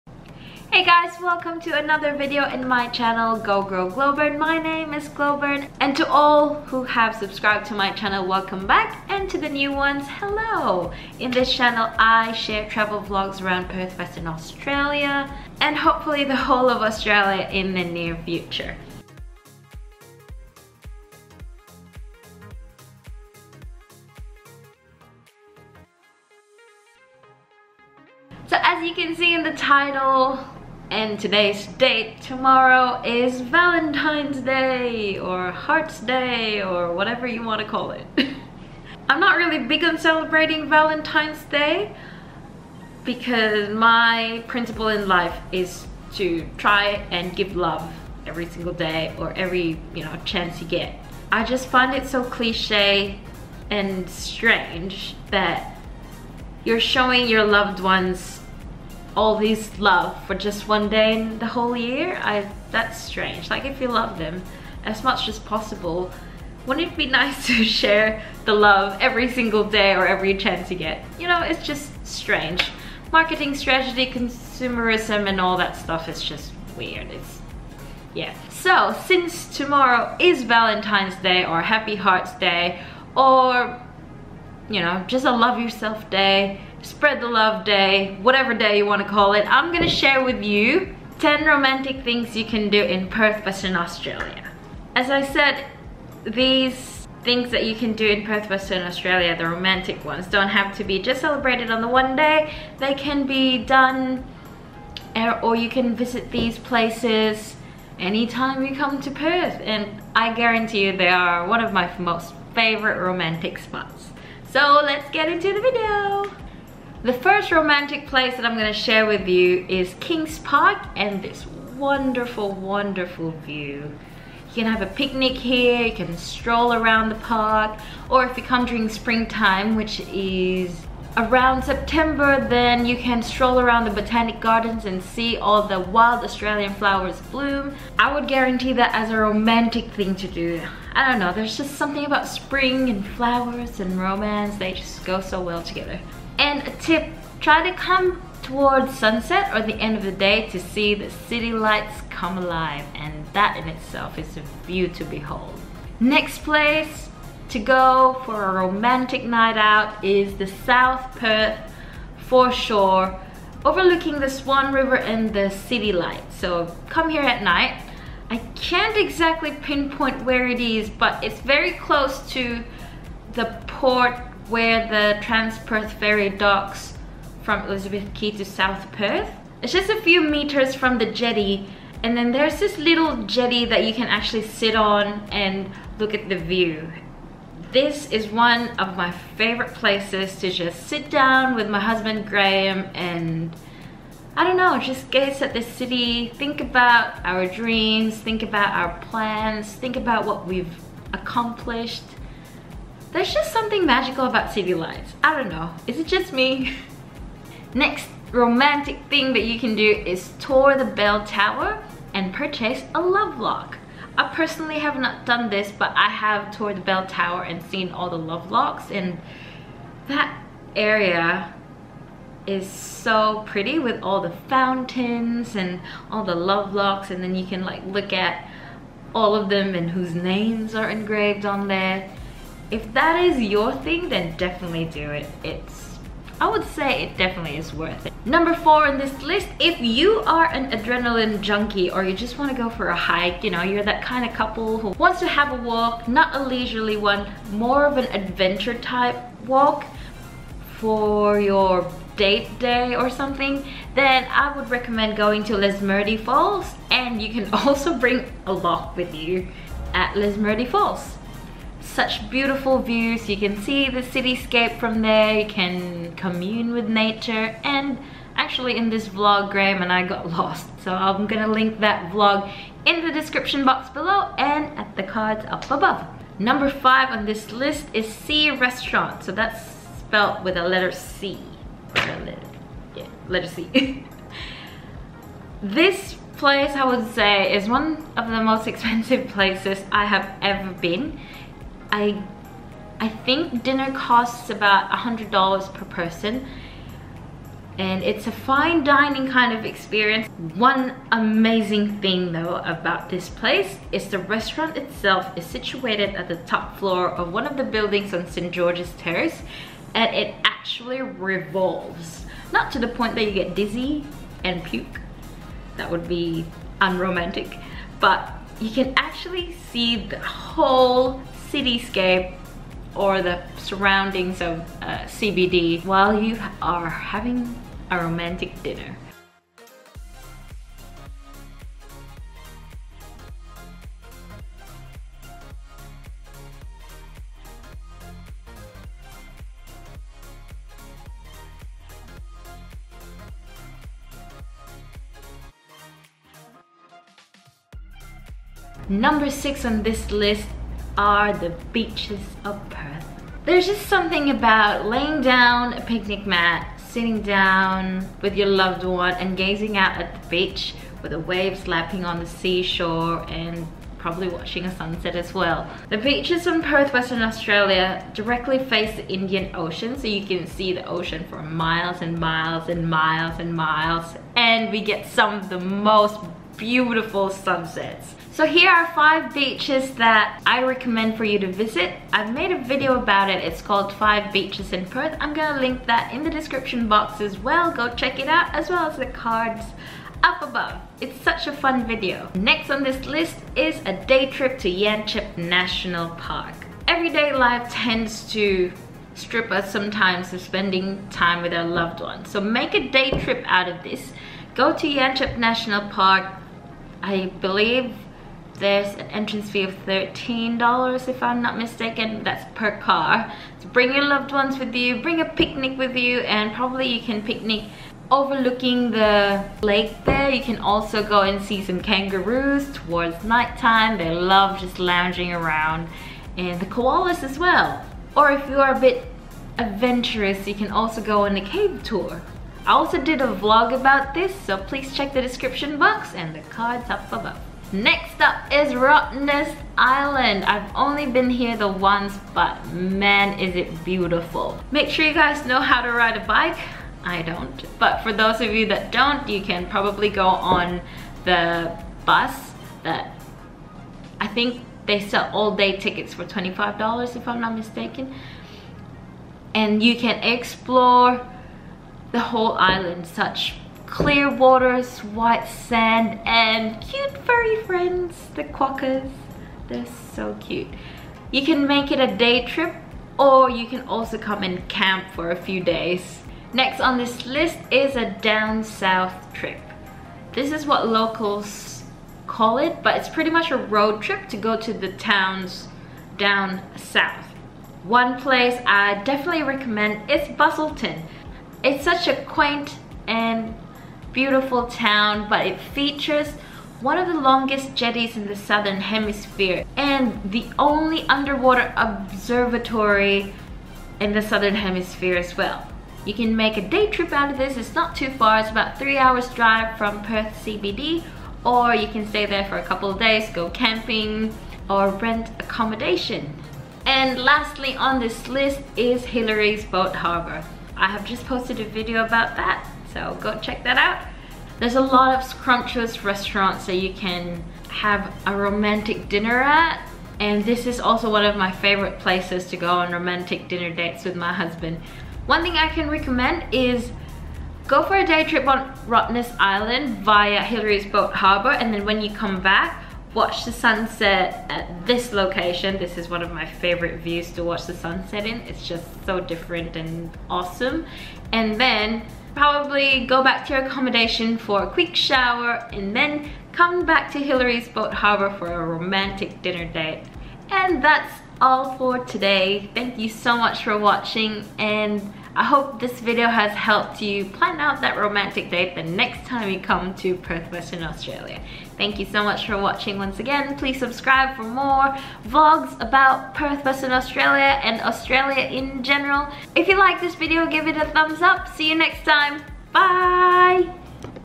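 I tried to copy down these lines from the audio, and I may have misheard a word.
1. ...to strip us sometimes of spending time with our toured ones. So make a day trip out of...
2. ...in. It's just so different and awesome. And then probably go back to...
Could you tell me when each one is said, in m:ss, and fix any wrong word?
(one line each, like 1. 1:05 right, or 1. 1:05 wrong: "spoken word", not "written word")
1. 6:38 wrong: "loved", not "toured"
2. 9:08 right.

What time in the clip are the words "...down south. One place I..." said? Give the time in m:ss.
8:06.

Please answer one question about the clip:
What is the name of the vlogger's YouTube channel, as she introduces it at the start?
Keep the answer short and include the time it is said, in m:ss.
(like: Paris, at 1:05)
Go Grow Glowbern, at 0:03.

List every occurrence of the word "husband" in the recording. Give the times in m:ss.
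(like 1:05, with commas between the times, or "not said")
3:11, 8:54.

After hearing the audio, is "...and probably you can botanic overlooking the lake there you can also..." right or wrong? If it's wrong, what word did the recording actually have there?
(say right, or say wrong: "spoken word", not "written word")
wrong: "picnic", not "botanic".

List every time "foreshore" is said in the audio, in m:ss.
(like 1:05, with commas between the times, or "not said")
2:42.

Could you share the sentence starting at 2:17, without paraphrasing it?
I would guarantee that as a romantic thing to do.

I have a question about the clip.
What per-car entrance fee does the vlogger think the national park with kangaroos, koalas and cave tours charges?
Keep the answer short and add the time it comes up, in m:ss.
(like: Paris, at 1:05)
$13, at 6:49.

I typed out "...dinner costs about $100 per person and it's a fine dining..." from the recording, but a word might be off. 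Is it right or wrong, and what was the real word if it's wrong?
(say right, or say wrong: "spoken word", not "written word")
right.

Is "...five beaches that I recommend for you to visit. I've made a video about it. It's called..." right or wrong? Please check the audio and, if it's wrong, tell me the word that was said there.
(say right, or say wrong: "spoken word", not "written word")
right.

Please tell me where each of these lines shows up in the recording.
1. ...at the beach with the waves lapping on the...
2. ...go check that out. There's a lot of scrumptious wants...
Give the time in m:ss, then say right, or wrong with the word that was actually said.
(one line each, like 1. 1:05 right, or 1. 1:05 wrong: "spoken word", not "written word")
1. 5:59 right
2. 8:43 wrong: "restaurants", not "wants".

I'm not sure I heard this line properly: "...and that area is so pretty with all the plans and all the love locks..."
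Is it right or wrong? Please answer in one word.
wrong.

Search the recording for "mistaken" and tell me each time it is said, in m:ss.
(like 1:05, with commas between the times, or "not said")
6:51, 7:37.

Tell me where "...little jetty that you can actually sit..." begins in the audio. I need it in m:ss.
3:02.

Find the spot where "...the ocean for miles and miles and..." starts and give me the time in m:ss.
6:10.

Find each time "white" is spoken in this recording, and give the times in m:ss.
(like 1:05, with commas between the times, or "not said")
7:45.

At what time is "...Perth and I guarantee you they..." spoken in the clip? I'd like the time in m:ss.
1:49.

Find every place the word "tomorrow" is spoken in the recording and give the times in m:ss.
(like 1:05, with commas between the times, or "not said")
0:32, 1:19.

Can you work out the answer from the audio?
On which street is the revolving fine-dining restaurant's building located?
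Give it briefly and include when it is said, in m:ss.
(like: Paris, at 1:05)
St. George's Terrace, at 5:08.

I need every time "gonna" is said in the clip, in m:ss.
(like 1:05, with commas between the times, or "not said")
1:29, 1:58, 4:31, 6:25.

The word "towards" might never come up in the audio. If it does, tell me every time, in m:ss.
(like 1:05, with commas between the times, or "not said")
2:28, 7:02.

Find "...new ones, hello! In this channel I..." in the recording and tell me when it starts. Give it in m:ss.
0:09.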